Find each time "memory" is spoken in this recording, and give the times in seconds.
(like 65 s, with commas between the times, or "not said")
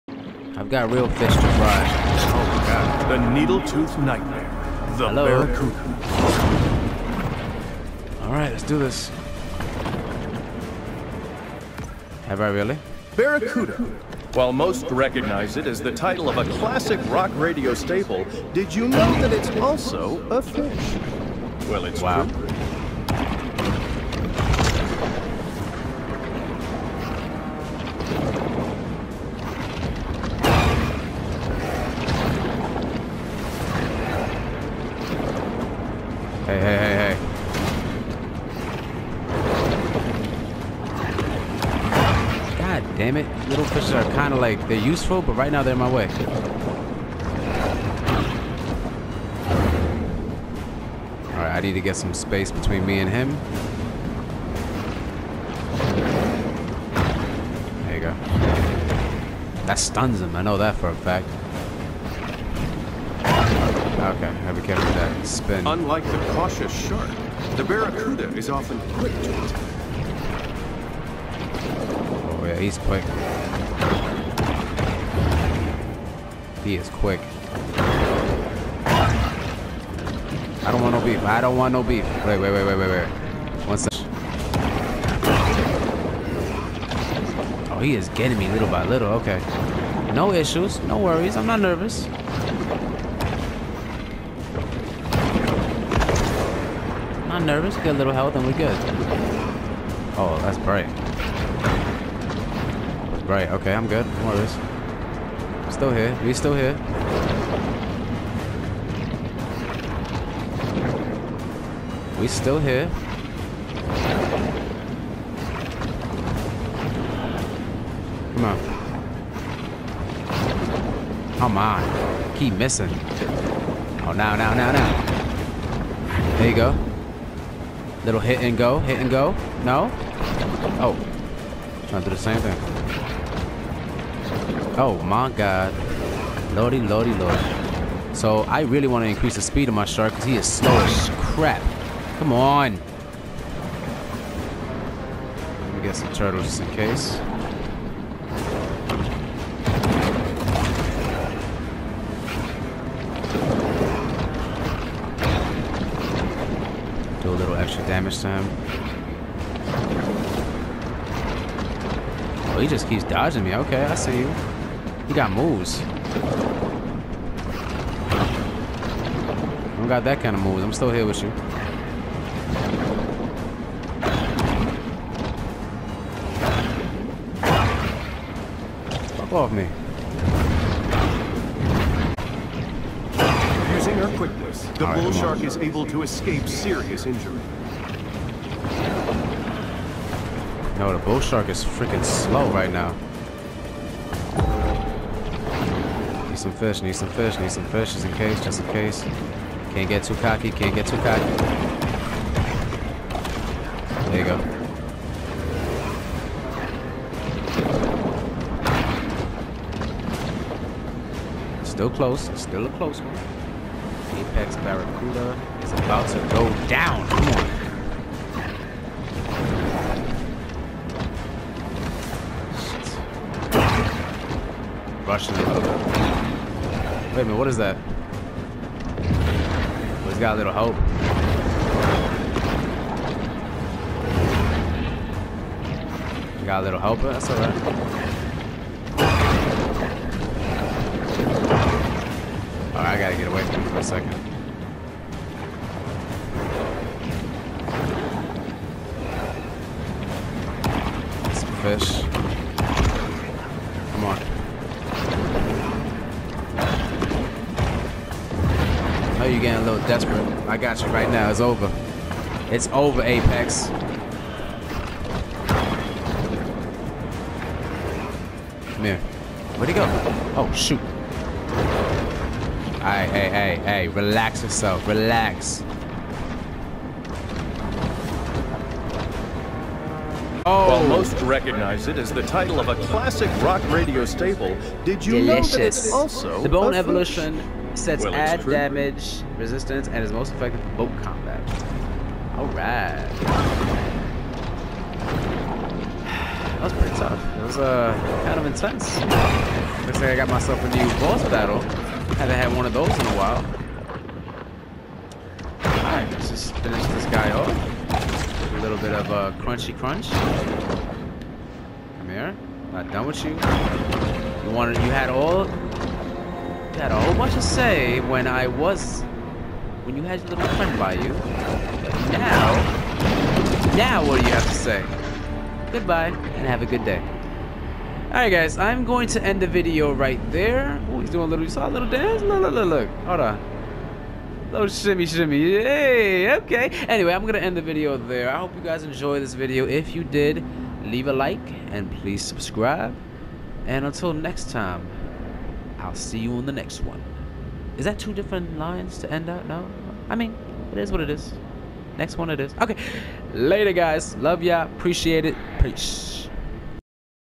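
not said.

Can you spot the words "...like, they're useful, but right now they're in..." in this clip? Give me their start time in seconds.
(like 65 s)
44 s.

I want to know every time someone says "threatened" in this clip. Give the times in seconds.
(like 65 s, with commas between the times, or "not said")
not said.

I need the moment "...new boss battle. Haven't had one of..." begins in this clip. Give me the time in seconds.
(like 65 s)
300 s.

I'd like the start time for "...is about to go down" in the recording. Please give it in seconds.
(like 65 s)
215 s.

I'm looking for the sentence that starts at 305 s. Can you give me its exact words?
Alright, let's just finish this guy off.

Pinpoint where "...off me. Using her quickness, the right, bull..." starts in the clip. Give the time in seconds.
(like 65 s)
179 s.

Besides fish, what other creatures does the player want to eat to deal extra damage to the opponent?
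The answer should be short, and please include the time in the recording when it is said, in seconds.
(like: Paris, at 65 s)
Turtles, at 146 s.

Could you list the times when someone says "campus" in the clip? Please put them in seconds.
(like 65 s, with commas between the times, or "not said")
not said.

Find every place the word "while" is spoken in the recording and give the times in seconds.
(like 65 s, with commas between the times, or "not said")
14 s, 280 s, 303 s.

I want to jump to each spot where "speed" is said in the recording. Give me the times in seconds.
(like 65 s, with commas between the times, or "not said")
139 s.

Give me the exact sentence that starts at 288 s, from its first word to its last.
damage, resistance, and is most effective for boat combat.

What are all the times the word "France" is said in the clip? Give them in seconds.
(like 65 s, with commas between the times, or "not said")
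not said.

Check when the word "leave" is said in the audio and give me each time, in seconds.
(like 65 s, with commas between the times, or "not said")
340 s.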